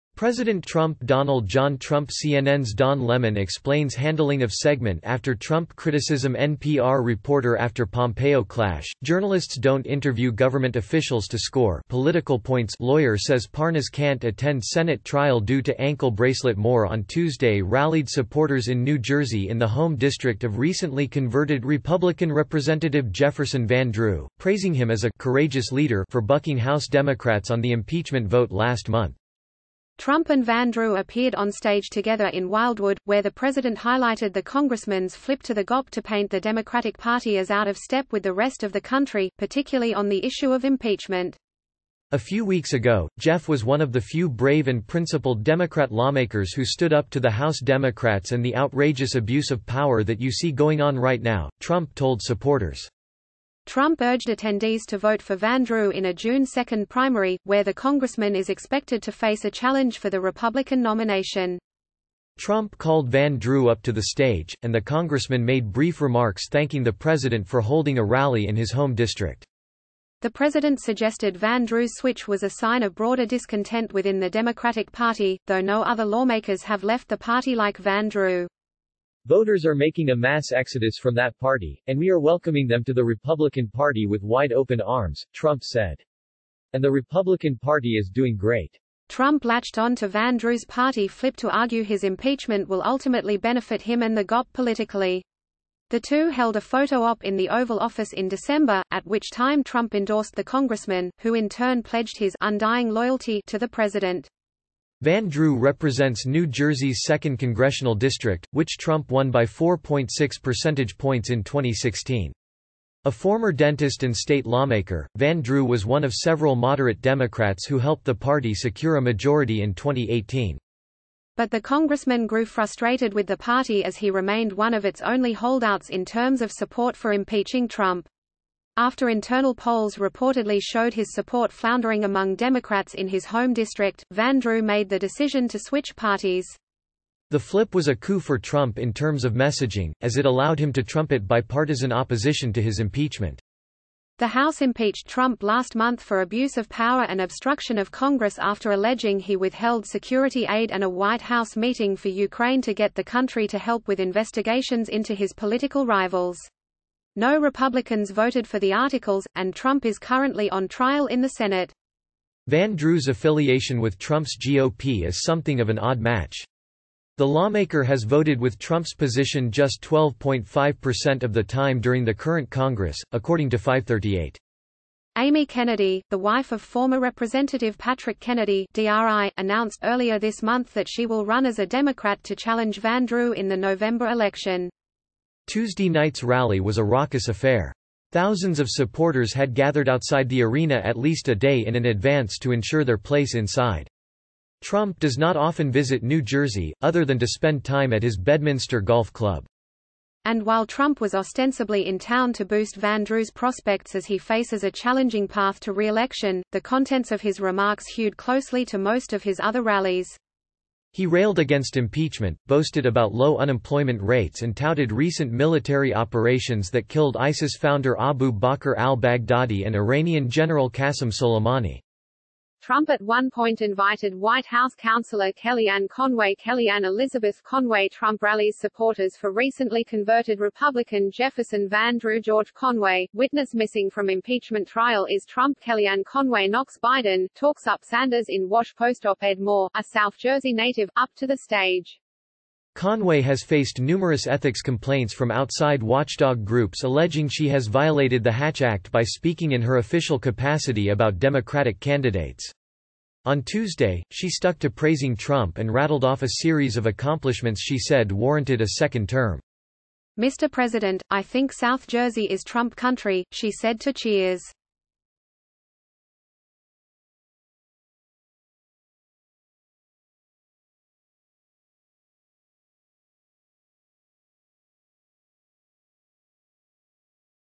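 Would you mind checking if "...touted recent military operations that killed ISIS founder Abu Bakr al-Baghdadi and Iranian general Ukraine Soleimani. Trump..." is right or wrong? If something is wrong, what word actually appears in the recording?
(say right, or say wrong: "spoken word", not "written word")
wrong: "Qasem", not "Ukraine".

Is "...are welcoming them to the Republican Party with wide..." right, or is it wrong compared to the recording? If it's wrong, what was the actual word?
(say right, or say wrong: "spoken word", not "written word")
right.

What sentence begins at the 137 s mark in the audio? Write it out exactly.
The flip was a coup for Trump in terms of messaging, as it allowed him to trumpet bipartisan opposition to his impeachment.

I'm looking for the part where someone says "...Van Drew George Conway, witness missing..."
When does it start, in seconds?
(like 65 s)
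231 s.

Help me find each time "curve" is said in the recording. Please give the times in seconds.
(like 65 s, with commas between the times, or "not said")
not said.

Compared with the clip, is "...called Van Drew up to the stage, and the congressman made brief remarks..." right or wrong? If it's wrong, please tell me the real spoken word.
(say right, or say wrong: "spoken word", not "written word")
right.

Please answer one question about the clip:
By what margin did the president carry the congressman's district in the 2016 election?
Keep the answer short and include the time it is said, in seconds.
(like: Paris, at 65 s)
4.6 percentage points, at 109 s.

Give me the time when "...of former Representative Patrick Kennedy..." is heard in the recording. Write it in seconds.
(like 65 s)
176 s.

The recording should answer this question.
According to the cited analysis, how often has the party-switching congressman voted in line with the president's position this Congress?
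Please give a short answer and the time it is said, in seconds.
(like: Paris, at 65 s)
12.5%, at 169 s.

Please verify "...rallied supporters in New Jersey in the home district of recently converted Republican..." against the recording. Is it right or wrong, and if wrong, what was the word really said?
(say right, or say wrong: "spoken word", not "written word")
right.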